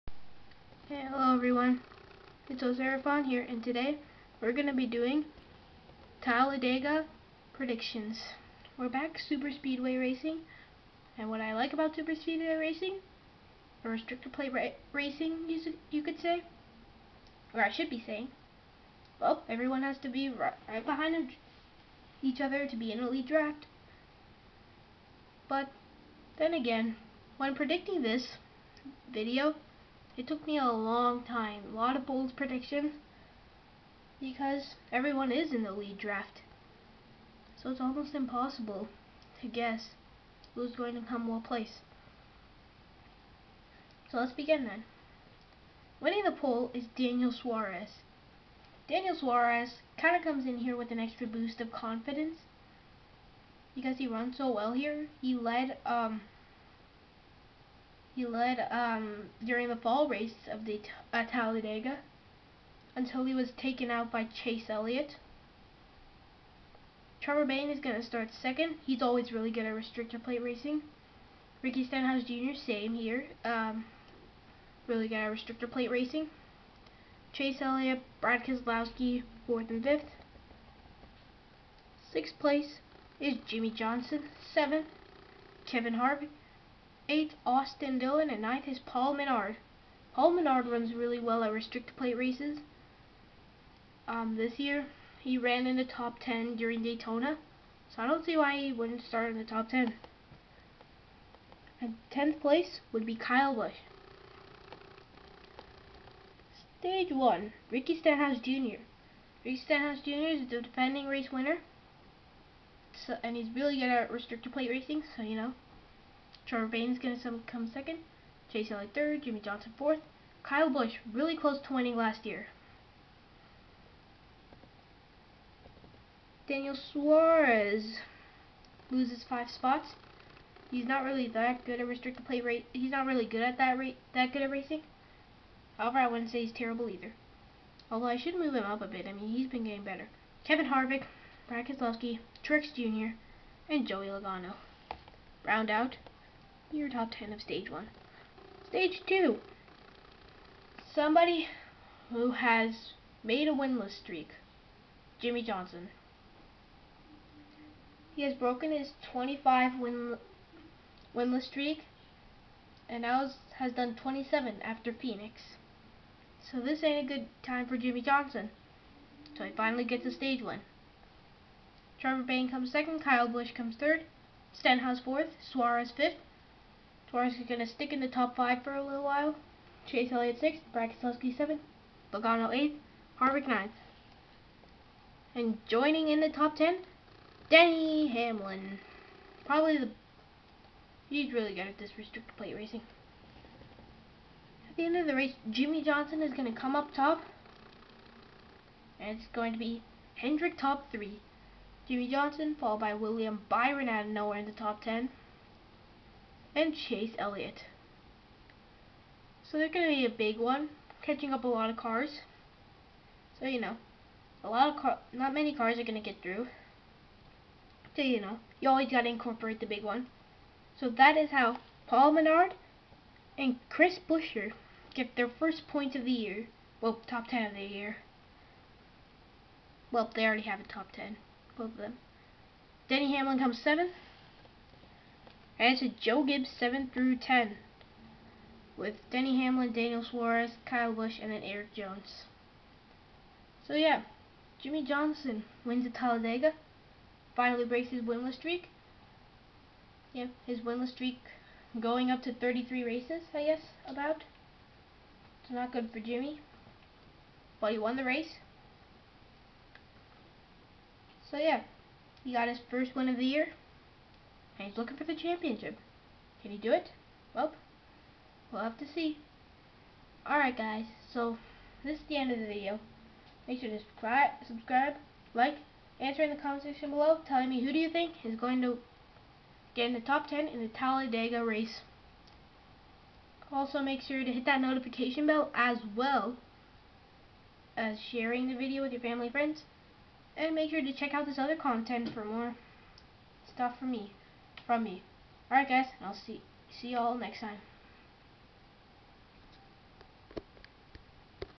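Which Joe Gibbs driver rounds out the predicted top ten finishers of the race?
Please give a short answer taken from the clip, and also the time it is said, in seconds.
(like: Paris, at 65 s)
Erik Jones, at 241 s.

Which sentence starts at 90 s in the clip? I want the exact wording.
Paul Menard runs really well at restricted plate races.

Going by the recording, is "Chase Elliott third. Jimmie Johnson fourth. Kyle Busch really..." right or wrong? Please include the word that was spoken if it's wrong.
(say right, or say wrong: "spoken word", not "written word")
right.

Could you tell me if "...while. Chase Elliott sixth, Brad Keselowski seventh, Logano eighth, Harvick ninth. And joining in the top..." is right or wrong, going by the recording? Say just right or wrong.
right.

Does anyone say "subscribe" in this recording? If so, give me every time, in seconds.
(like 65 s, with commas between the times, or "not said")
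274 s.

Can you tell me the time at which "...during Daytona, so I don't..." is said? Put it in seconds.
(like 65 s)
96 s.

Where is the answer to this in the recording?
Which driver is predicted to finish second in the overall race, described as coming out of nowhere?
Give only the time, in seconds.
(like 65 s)
202 s.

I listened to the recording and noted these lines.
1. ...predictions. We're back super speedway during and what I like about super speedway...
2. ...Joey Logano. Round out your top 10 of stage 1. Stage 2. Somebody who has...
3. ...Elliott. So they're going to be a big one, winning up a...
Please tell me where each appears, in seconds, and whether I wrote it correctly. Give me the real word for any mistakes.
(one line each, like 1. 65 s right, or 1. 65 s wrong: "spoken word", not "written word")
1. 7 s wrong: "racing", not "during"
2. 143 s right
3. 207 s wrong: "catching", not "winning".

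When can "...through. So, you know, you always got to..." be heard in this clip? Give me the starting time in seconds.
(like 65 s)
216 s.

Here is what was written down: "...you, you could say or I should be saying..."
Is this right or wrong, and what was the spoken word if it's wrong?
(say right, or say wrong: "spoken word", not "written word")
right.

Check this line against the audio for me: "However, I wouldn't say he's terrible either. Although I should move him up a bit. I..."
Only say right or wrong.
right.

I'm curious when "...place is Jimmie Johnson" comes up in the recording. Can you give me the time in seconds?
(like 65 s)
82 s.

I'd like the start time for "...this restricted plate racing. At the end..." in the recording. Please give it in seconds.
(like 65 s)
191 s.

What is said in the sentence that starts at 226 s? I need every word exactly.
Well, top 10 of the year.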